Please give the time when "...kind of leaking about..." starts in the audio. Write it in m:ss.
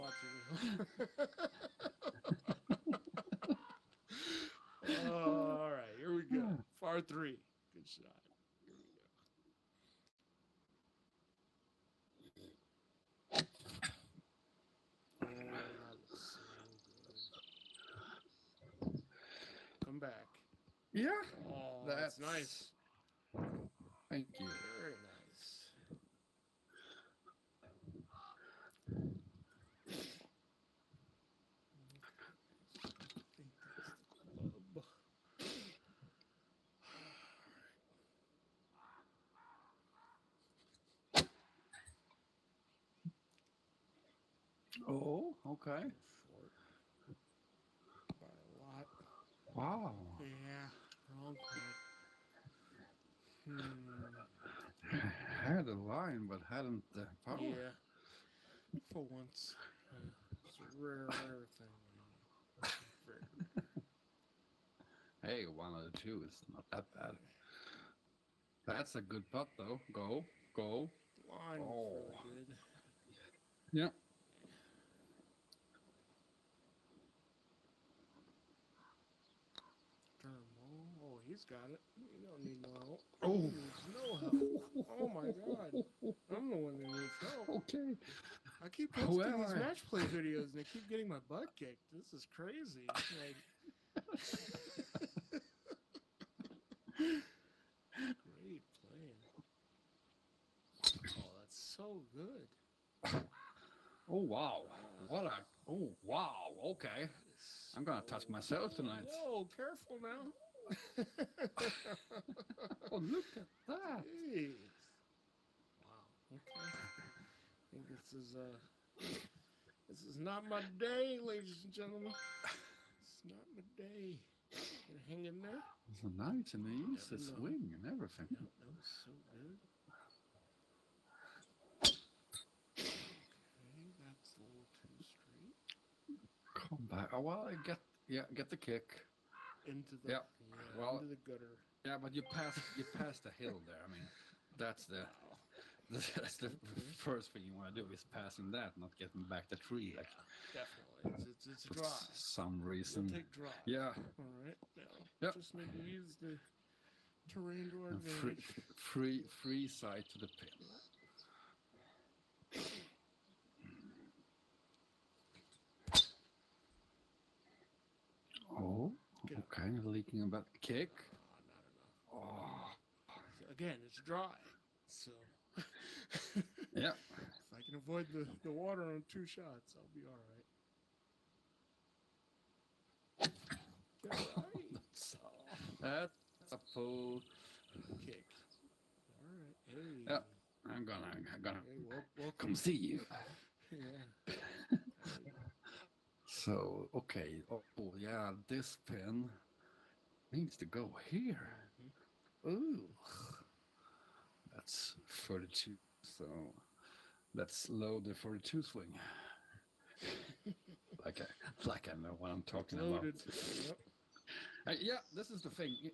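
2:49.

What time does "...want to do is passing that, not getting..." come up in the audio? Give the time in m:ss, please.
2:27.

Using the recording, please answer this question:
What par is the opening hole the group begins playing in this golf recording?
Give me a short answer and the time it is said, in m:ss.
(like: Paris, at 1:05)
3, at 0:07.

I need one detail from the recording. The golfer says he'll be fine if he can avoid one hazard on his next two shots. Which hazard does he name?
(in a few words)
The water.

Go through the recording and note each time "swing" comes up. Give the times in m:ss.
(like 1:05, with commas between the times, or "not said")
2:07, 3:28.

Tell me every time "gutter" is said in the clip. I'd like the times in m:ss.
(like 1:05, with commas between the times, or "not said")
2:21.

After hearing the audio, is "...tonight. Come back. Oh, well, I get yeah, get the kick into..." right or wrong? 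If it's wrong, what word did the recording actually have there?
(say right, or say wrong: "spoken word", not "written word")
wrong: "straight", not "tonight".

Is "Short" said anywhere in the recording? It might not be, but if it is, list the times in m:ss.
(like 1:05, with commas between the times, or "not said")
0:45.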